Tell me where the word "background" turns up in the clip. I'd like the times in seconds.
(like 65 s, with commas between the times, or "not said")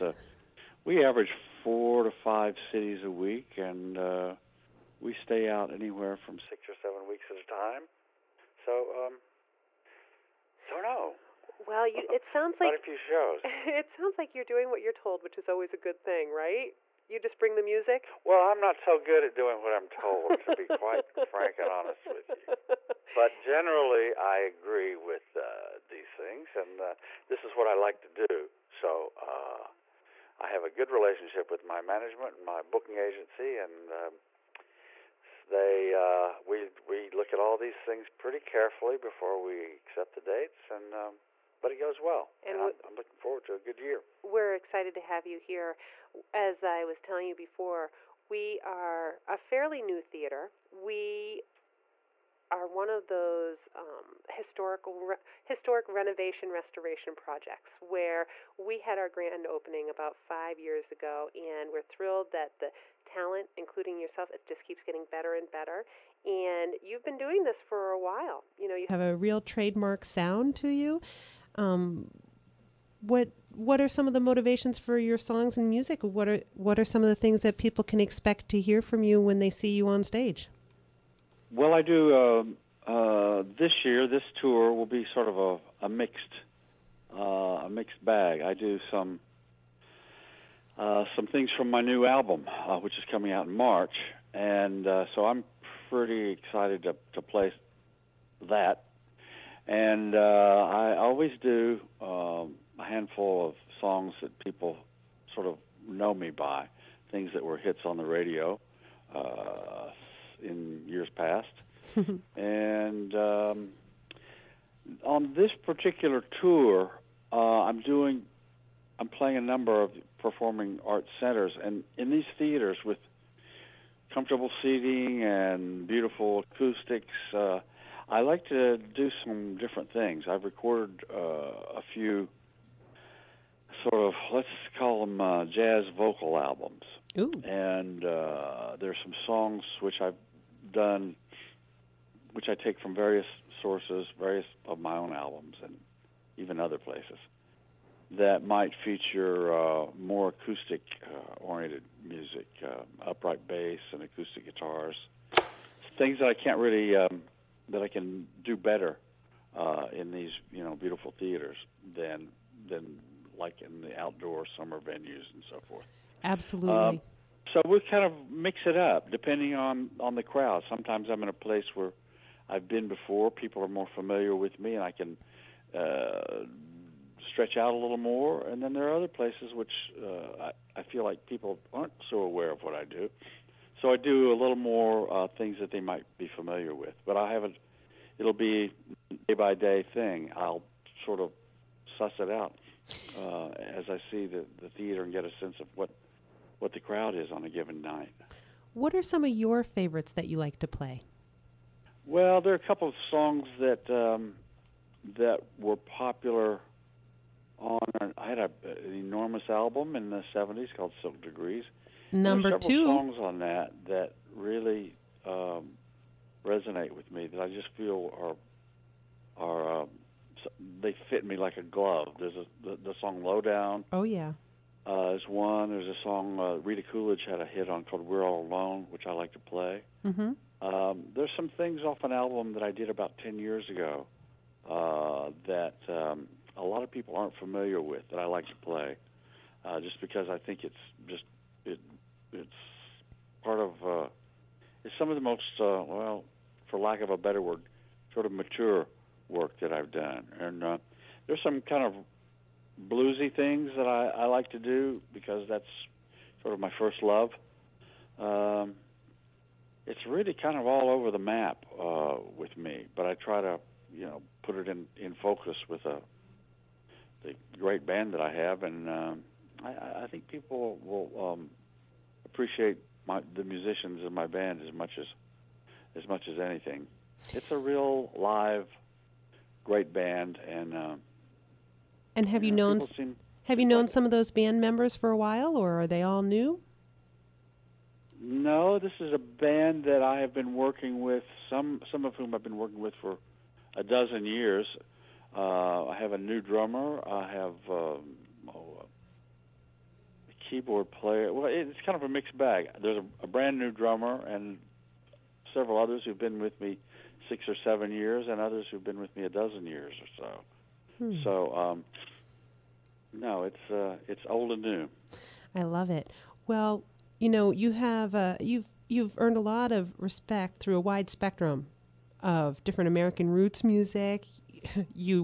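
not said.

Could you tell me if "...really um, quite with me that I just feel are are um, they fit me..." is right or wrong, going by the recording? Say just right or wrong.
wrong.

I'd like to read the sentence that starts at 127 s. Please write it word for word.
Uh, I like to do some different things.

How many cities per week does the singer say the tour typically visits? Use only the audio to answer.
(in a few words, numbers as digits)
4 to 5.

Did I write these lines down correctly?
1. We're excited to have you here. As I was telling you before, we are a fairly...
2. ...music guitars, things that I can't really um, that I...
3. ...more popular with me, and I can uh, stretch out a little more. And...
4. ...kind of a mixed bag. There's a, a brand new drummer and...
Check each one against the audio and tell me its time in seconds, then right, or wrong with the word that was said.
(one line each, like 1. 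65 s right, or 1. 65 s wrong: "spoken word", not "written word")
1. 44 s right
2. 154 s wrong: "acoustic", not "music"
3. 173 s wrong: "familiar", not "popular"
4. 301 s right.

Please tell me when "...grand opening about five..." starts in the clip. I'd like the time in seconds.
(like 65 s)
59 s.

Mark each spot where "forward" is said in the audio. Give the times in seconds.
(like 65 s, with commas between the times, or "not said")
43 s.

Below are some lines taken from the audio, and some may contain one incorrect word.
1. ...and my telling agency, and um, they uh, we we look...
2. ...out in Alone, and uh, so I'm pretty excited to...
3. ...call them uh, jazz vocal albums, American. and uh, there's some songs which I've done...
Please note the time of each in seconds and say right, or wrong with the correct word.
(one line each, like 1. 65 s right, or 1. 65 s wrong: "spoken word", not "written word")
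1. 32 s wrong: "booking", not "telling"
2. 93 s wrong: "March", not "Alone"
3. 134 s wrong: "Ooh", not "American".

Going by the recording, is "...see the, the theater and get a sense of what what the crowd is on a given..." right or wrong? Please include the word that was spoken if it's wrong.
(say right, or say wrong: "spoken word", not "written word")
right.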